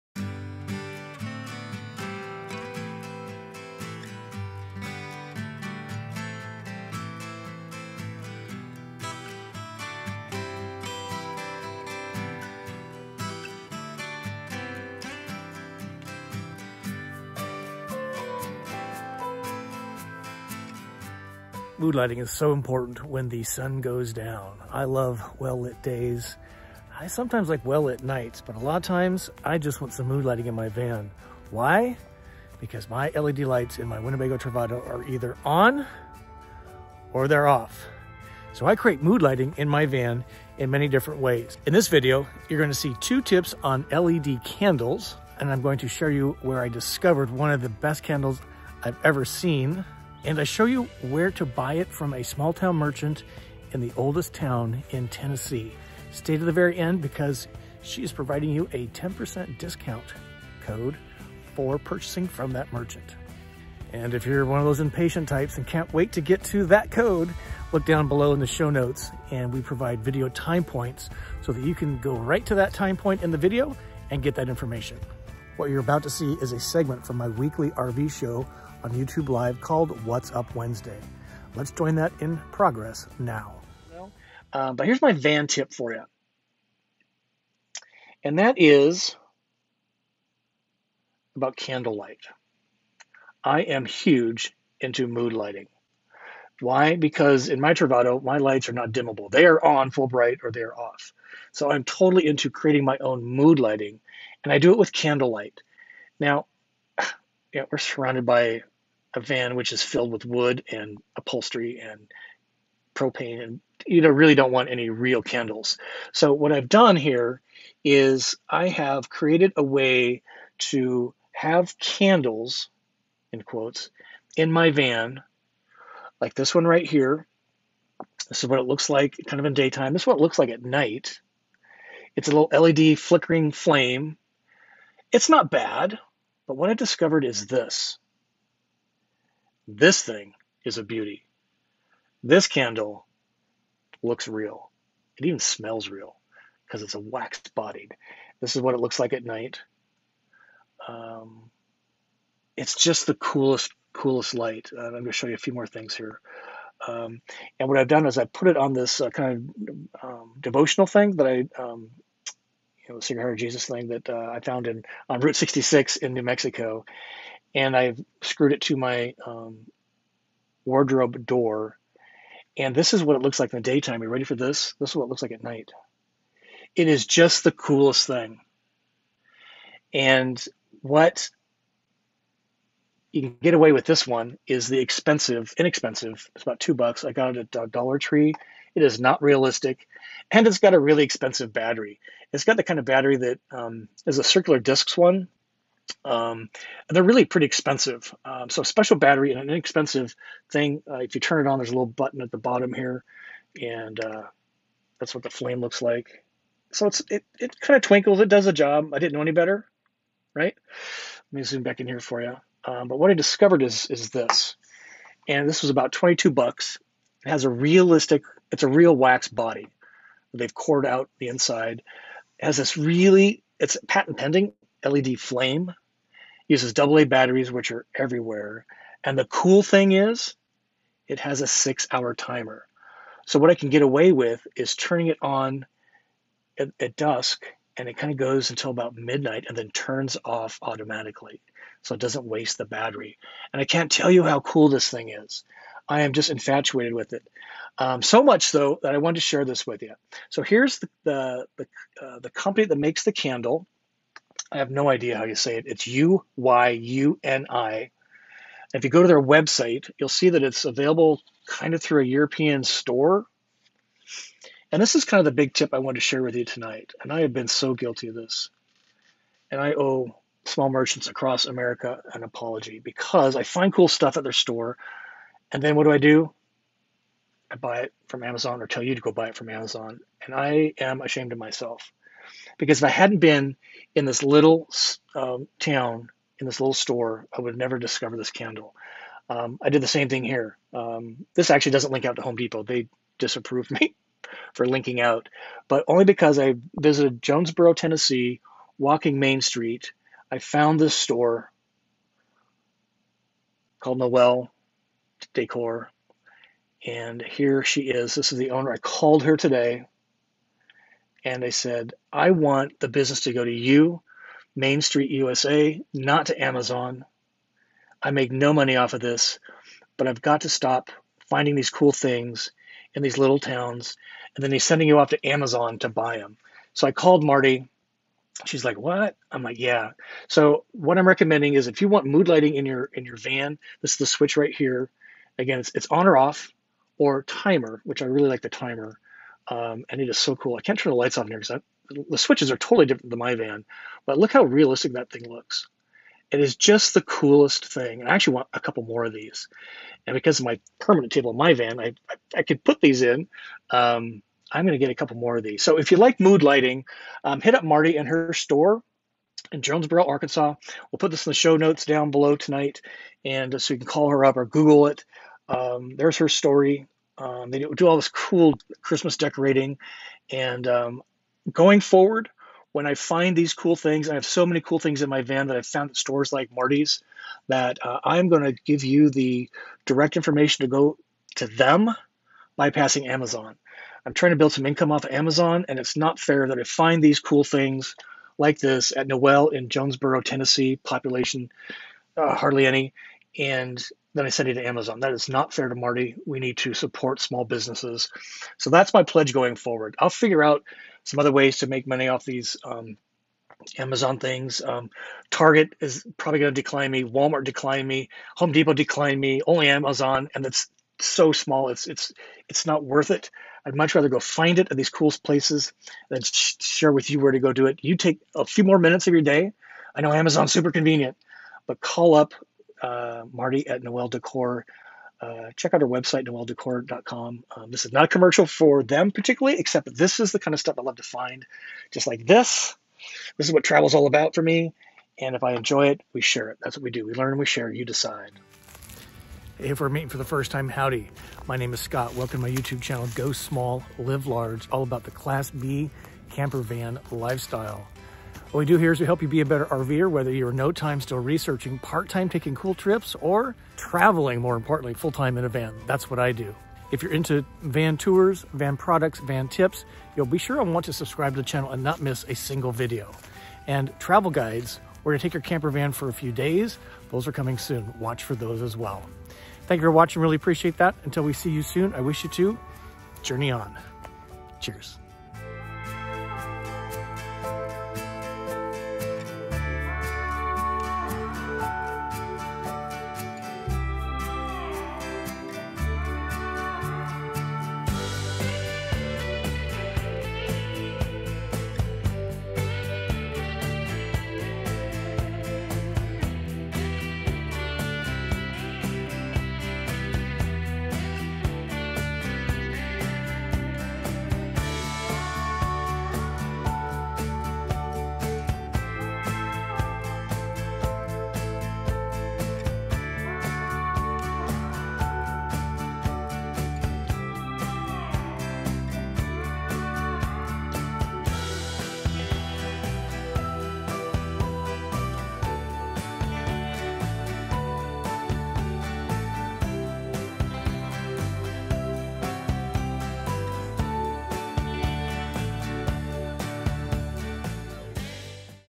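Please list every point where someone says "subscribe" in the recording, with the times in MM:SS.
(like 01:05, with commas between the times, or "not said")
07:40.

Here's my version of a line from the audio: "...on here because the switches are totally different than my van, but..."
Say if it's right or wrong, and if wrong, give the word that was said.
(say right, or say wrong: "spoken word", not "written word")
right.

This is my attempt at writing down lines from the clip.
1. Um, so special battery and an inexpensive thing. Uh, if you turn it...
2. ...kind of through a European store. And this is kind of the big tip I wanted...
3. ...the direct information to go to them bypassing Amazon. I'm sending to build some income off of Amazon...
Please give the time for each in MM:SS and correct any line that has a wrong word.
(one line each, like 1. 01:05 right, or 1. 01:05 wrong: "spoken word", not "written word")
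1. 03:18 right
2. 04:21 right
3. 06:19 wrong: "trying", not "sending".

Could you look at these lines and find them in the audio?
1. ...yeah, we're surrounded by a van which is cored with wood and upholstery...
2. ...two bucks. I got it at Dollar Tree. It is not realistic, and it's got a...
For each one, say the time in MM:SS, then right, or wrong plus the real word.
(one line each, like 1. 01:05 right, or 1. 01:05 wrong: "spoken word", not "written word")
1. 01:47 wrong: "filled", not "cored"
2. 03:06 right.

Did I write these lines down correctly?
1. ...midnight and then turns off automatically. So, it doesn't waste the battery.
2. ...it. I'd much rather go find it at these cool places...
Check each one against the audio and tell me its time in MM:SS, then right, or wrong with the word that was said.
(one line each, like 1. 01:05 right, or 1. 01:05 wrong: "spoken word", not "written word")
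1. 03:58 right
2. 06:53 right.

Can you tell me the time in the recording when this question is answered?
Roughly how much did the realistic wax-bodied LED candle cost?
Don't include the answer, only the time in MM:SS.
03:35.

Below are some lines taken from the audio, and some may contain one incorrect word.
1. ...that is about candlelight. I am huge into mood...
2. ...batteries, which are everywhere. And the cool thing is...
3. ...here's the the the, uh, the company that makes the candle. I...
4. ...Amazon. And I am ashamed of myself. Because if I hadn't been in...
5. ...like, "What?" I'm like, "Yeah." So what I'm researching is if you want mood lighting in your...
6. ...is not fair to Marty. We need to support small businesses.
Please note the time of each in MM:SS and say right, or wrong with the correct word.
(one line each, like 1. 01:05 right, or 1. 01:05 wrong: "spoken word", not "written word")
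1. 01:28 right
2. 03:47 right
3. 04:10 right
4. 04:39 right
5. 05:28 wrong: "recommending", not "researching"
6. 06:35 right.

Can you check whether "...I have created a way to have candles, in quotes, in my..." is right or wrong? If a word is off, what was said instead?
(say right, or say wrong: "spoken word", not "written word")
right.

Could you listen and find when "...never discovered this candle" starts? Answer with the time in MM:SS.
04:47.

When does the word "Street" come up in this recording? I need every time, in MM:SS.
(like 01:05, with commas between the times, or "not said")
04:59, 05:14.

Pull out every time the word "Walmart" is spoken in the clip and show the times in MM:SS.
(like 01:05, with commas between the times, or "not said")
06:47.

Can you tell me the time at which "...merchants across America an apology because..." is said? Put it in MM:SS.
04:30.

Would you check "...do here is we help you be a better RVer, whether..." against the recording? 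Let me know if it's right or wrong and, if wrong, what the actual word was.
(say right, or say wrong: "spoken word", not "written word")
right.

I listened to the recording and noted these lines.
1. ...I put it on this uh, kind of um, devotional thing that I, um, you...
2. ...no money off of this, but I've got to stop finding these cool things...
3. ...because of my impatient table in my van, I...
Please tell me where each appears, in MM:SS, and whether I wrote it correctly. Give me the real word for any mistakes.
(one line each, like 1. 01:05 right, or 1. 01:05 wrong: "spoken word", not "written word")
1. 02:38 right
2. 05:18 right
3. 05:50 wrong: "permanent", not "impatient".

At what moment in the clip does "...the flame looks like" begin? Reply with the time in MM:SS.
03:25.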